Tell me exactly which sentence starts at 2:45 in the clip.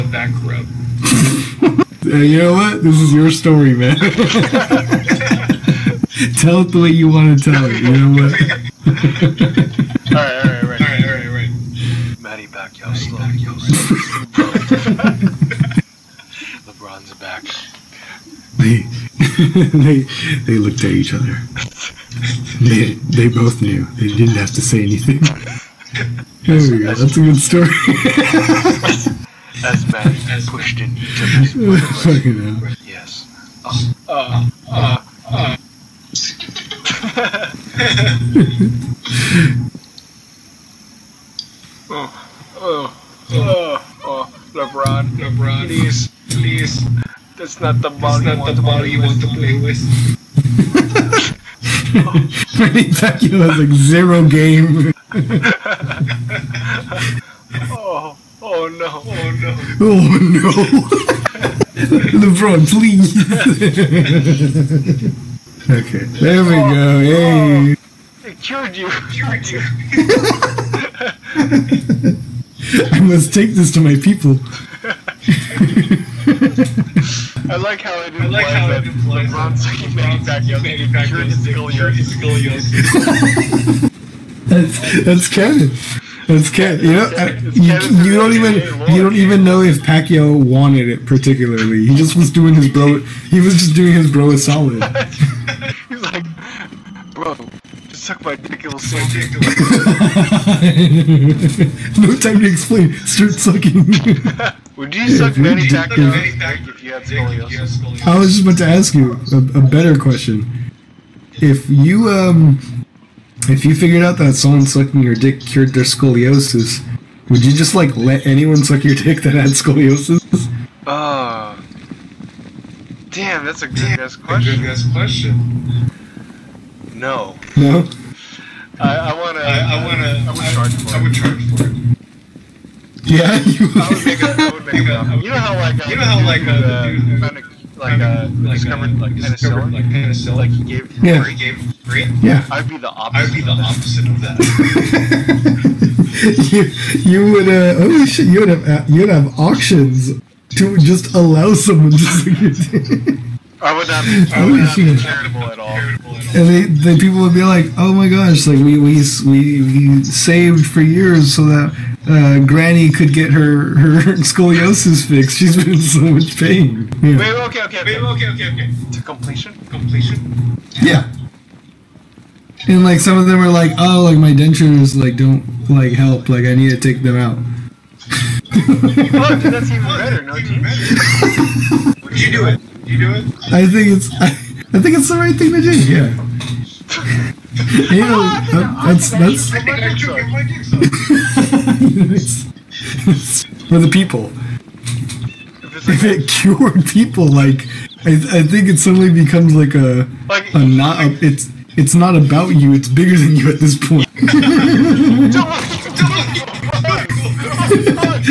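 She's been in so much pain.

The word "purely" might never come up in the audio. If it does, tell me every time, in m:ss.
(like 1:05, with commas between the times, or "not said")
not said.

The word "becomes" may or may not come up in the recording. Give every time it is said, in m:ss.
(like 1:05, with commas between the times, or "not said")
3:19.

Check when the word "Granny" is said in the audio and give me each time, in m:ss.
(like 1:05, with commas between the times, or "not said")
2:42.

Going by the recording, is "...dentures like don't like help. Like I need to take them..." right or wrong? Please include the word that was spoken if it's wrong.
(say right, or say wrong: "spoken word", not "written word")
right.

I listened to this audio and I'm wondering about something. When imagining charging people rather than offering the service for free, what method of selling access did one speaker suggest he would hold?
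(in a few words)
Auctions.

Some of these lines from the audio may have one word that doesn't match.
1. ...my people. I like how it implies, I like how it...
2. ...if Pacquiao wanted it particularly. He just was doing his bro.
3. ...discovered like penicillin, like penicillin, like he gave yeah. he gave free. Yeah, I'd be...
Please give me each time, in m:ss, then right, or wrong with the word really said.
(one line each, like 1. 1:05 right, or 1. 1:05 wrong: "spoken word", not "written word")
1. 1:13 right
2. 1:29 right
3. 2:18 right.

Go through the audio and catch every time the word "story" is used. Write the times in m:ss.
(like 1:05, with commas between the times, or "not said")
0:03, 0:27.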